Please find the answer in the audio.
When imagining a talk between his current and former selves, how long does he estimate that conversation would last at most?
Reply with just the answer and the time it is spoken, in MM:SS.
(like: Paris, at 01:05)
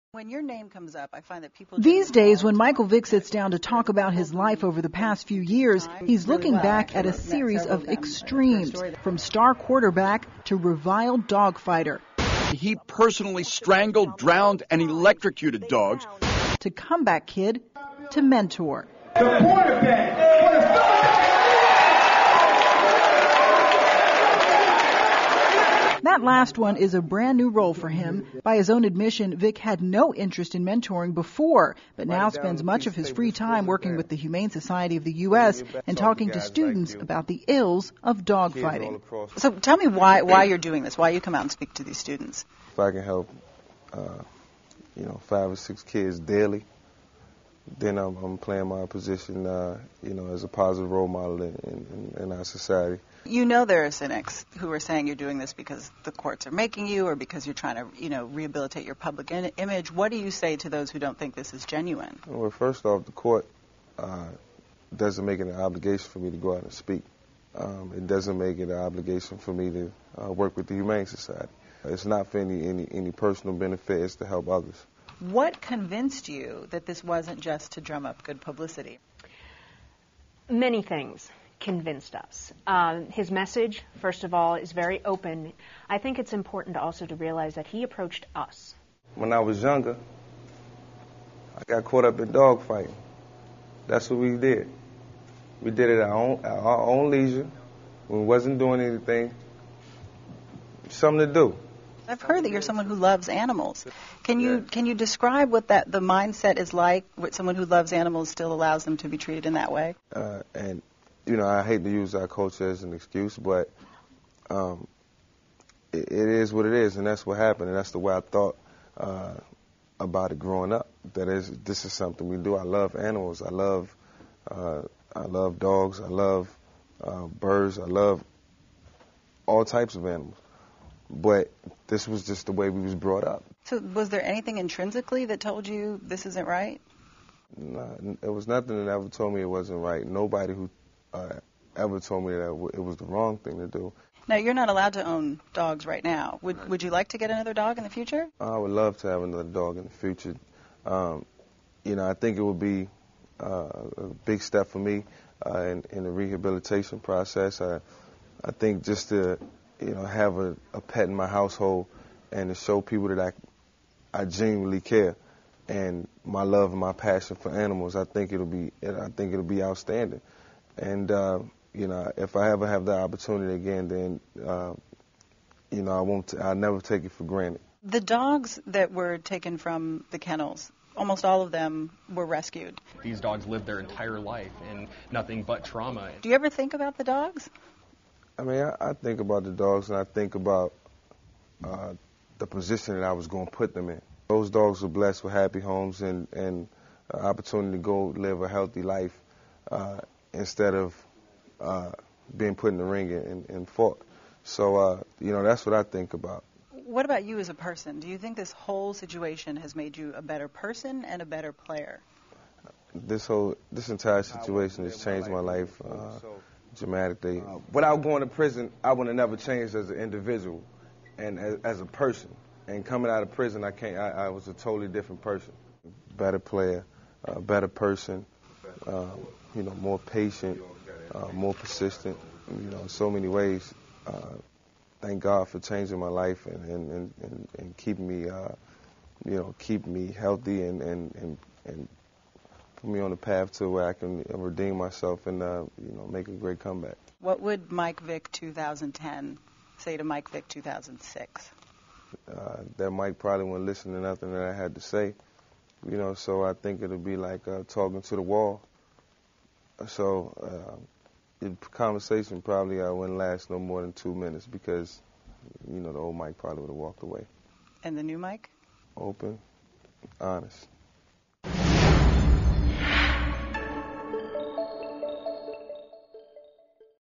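2 minutes, at 04:23.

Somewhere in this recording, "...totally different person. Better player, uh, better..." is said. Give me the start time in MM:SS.
03:44.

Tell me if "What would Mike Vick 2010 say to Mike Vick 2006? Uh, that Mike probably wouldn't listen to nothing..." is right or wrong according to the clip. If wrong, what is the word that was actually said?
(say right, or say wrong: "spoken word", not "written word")
right.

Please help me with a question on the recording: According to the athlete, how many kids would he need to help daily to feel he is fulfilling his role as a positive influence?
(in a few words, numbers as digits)
5 or 6.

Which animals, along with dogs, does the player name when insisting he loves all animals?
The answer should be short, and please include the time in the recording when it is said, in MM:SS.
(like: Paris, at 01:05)
birds, at 02:07.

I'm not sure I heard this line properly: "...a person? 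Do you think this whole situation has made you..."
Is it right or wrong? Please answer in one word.
right.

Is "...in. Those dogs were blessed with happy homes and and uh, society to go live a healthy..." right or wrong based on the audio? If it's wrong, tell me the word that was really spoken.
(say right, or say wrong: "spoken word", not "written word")
wrong: "opportunity", not "society".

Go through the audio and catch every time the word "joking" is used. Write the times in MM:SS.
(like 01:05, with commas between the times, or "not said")
not said.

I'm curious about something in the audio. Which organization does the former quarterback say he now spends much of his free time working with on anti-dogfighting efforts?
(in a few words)
Humane Society of the U.S.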